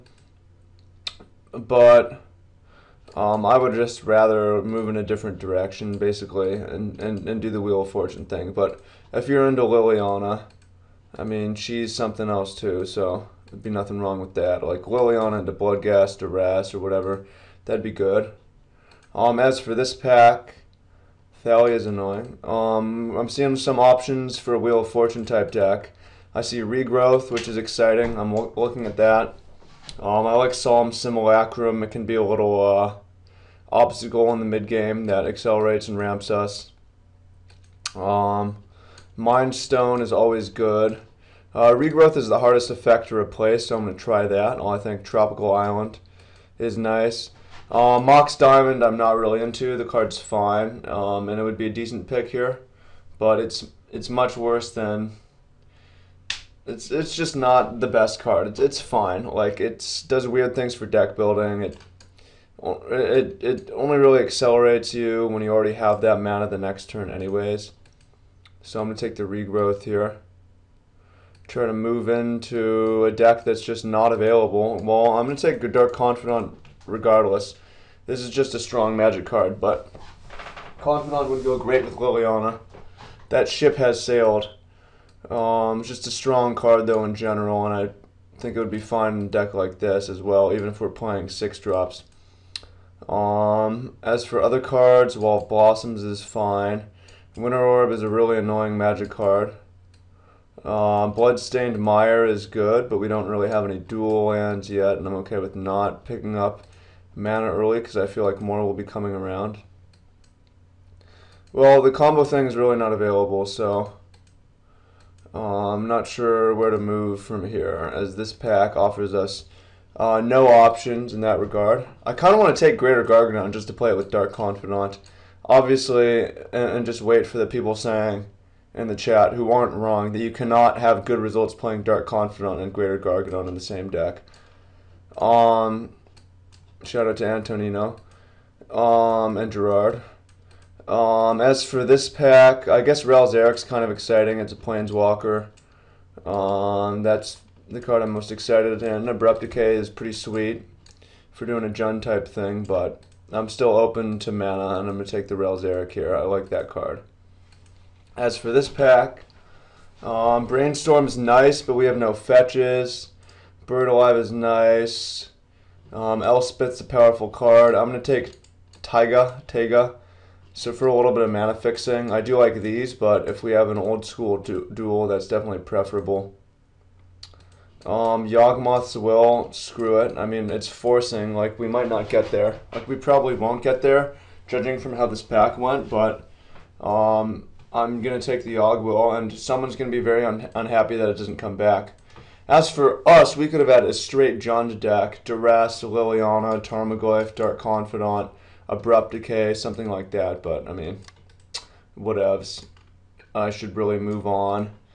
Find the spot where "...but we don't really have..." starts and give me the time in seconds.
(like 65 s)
102 s.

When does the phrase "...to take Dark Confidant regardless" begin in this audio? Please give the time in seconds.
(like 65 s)
75 s.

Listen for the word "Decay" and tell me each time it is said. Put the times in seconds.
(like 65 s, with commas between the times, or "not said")
149 s, 199 s.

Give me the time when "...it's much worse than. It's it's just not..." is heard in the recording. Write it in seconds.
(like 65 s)
53 s.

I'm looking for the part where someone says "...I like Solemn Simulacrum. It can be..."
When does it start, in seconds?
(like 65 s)
30 s.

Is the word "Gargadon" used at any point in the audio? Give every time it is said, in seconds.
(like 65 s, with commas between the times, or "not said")
123 s, 132 s.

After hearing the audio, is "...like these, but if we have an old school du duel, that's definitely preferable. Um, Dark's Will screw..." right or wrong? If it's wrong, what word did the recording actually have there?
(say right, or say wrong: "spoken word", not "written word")
wrong: "Yawgmoth", not "Dark".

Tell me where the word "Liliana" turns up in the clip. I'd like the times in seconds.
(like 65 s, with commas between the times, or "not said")
9 s, 14 s, 81 s, 195 s.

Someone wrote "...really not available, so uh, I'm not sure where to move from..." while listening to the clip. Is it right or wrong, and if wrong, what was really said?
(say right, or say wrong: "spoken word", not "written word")
right.